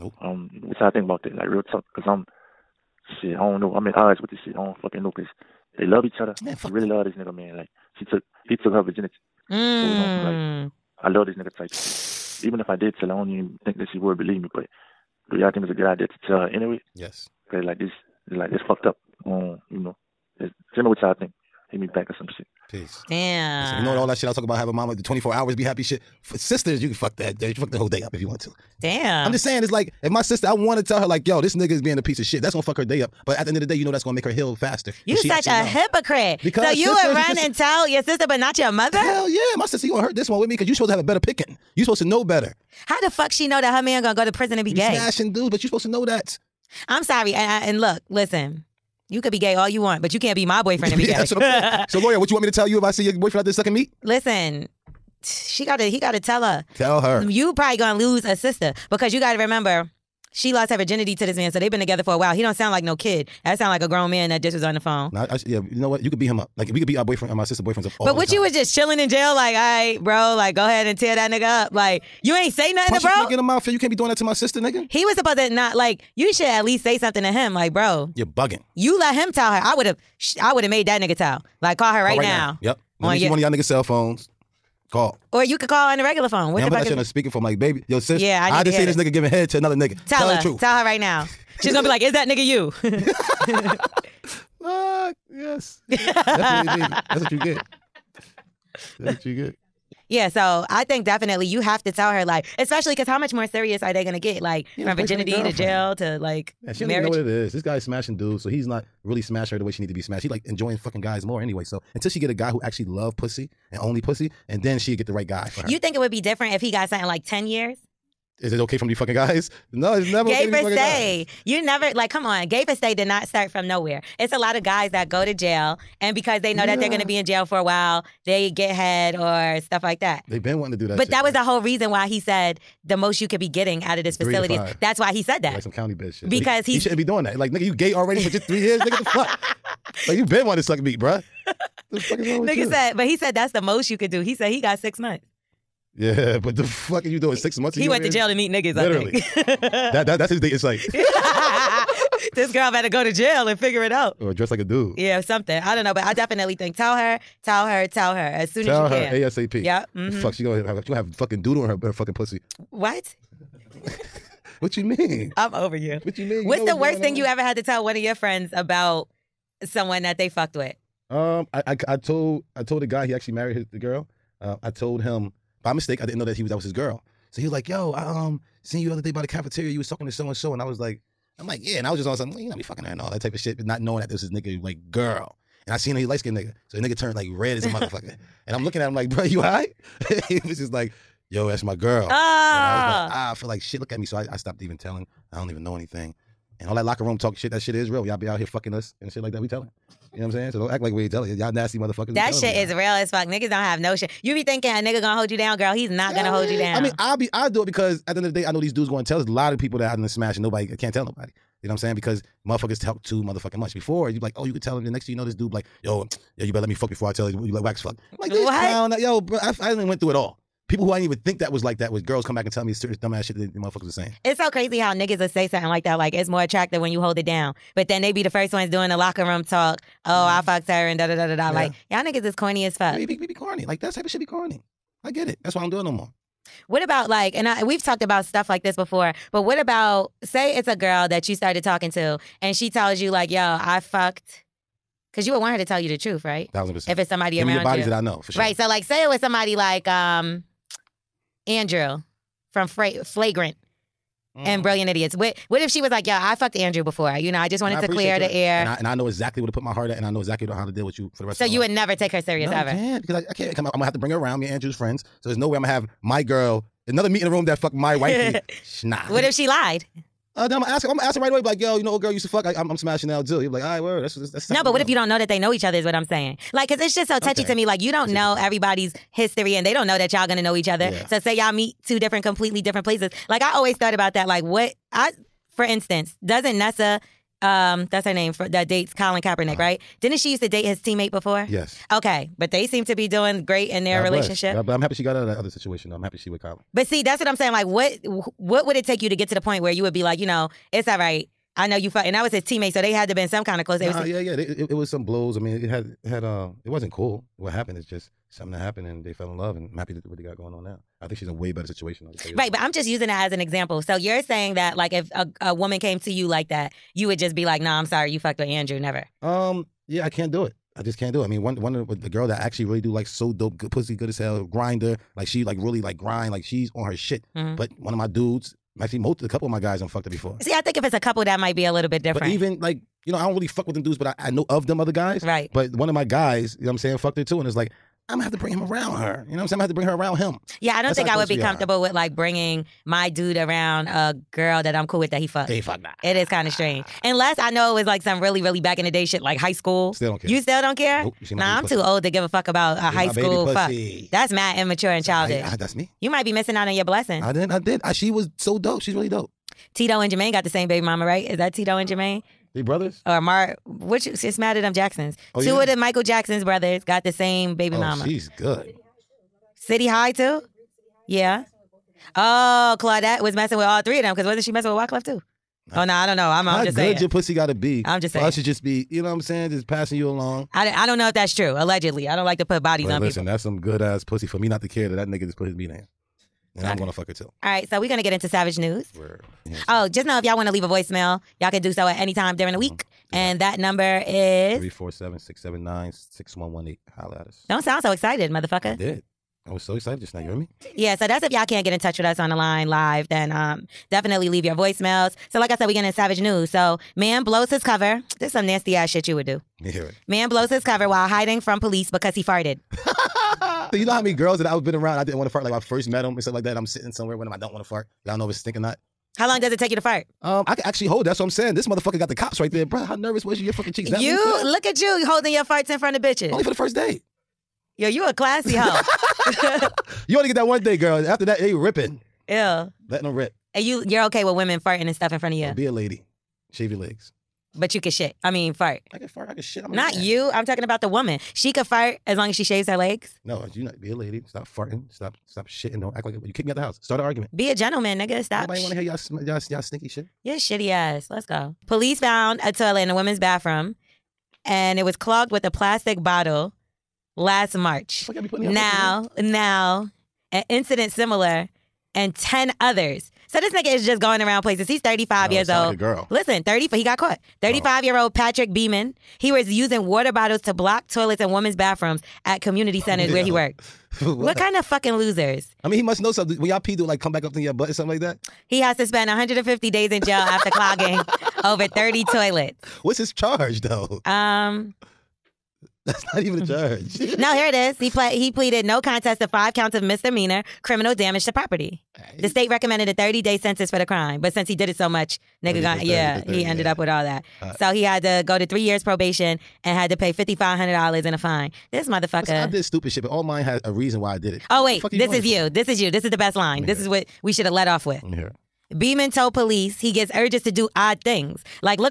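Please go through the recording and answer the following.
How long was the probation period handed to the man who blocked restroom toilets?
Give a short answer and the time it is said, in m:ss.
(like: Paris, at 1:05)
3 years, at 8:18.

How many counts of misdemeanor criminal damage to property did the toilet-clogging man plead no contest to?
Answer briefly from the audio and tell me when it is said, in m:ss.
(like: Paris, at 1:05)
5, at 8:09.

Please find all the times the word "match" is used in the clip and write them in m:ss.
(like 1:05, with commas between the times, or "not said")
not said.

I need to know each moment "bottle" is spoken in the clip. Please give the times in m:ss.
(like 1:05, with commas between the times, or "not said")
7:35, 7:50.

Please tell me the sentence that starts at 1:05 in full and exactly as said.
Nah, I, I, yeah, you know what?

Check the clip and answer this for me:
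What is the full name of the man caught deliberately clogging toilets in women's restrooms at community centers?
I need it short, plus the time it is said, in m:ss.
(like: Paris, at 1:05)
Patrick Beeman, at 7:48.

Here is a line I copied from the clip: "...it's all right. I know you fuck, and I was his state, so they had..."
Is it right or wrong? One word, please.
wrong.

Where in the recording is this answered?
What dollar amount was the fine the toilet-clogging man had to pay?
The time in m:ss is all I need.
8:20.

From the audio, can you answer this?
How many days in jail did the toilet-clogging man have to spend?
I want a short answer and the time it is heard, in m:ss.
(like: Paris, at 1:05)
150 days, at 7:59.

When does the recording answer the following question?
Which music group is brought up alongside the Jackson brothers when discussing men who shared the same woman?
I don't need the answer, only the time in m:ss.
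6:09.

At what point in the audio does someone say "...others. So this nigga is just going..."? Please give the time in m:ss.
7:42.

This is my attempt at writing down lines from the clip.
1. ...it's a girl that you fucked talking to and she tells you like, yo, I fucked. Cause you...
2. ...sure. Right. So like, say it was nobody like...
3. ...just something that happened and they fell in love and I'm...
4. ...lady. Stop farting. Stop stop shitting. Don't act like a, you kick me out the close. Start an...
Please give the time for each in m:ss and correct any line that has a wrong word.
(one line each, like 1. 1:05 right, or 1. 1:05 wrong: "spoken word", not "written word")
1. 4:00 wrong: "started", not "fucked"
2. 4:08 wrong: "somebody", not "nobody"
3. 5:07 right
4. 7:23 wrong: "house", not "close".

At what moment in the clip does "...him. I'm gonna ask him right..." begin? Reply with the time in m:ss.
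4:30.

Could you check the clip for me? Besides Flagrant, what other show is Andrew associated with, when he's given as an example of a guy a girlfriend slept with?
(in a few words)
Brilliant Idiots.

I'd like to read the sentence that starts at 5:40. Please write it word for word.
Yeah, I don't That's think I would be comfortable are.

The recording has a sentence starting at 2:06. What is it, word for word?
that they're gonna be in jail for a while, they get head or stuff like that.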